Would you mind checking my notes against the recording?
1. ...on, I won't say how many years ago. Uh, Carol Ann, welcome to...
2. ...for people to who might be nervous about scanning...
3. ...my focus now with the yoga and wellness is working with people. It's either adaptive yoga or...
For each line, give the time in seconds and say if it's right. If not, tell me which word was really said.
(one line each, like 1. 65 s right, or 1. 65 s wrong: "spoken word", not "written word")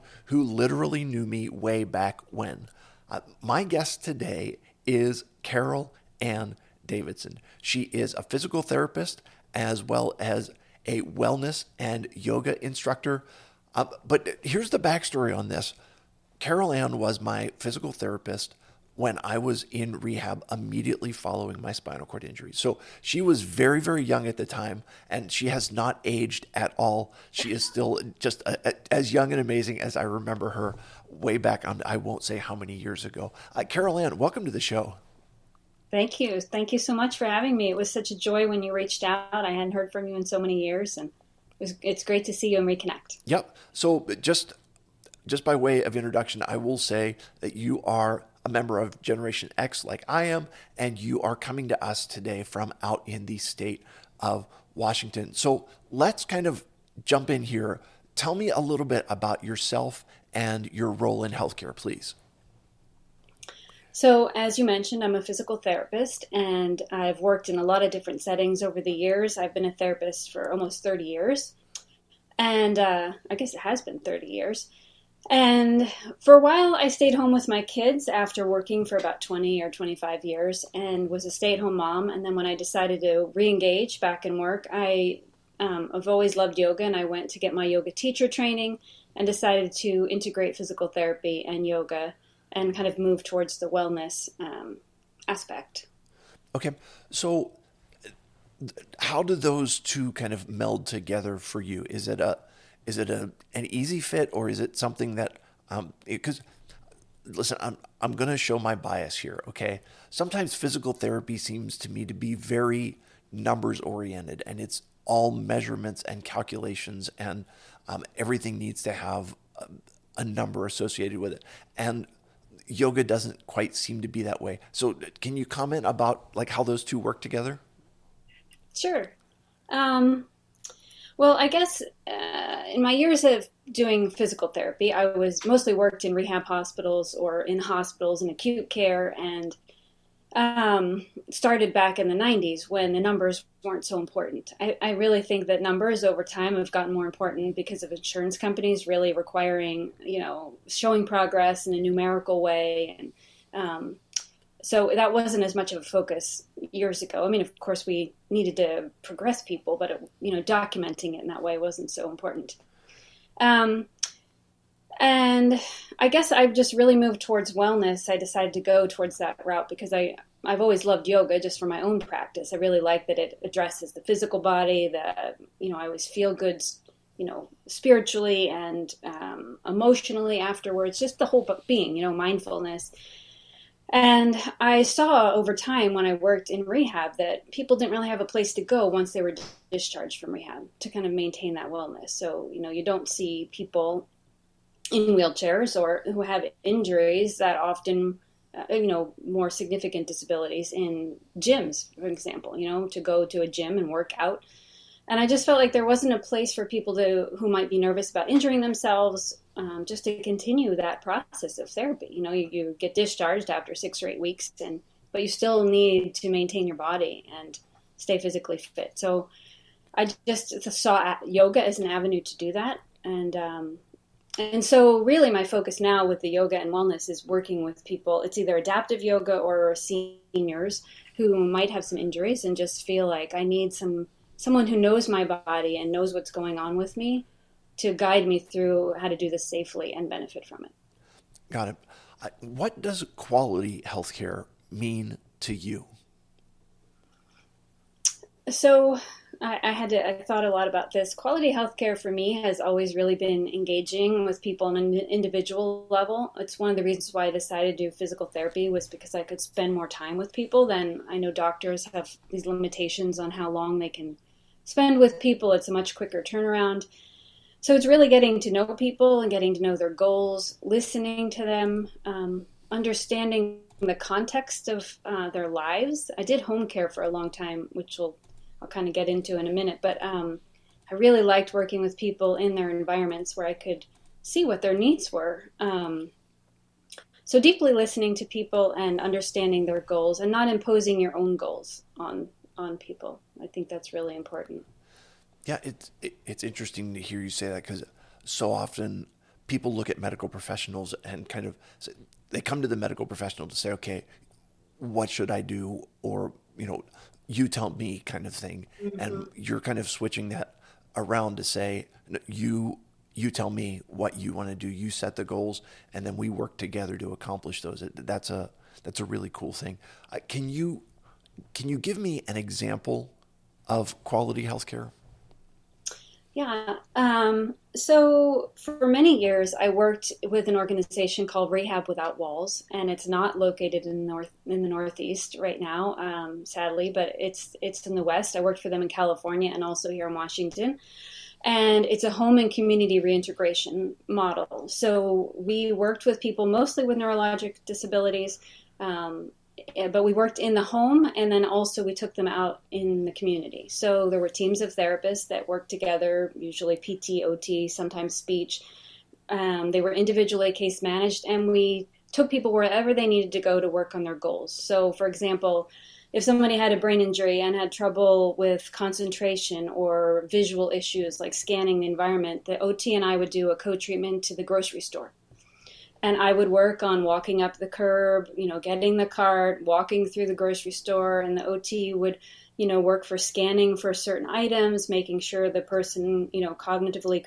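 1. 31 s right
2. 206 s wrong: "injuring", not "scanning"
3. 225 s right.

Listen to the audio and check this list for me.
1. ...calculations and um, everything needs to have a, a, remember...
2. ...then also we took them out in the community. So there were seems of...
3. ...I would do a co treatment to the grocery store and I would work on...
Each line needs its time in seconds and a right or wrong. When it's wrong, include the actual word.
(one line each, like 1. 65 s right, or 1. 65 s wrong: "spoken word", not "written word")
1. 116 s wrong: "number", not "remember"
2. 351 s wrong: "teams", not "seems"
3. 373 s right.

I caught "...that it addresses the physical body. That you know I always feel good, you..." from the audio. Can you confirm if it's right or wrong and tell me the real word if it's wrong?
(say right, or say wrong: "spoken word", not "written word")
right.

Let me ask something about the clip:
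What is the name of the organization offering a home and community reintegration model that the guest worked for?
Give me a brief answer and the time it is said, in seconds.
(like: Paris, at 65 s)
Rehab Without Walls, at 331 s.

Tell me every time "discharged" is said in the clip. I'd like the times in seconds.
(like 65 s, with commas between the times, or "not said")
189 s, 212 s.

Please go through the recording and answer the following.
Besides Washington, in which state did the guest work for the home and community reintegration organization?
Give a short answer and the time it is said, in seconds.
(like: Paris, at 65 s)
California, at 338 s.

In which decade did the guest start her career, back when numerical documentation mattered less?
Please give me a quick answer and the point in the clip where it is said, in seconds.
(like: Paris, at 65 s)
the 90s, at 142 s.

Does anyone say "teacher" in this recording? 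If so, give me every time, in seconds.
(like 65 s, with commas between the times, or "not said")
87 s.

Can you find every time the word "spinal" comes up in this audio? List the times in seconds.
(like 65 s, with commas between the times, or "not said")
21 s.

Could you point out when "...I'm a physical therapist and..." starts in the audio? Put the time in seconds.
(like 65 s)
65 s.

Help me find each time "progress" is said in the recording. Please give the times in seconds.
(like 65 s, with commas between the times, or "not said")
151 s, 159 s.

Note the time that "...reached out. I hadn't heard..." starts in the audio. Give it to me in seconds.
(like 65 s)
38 s.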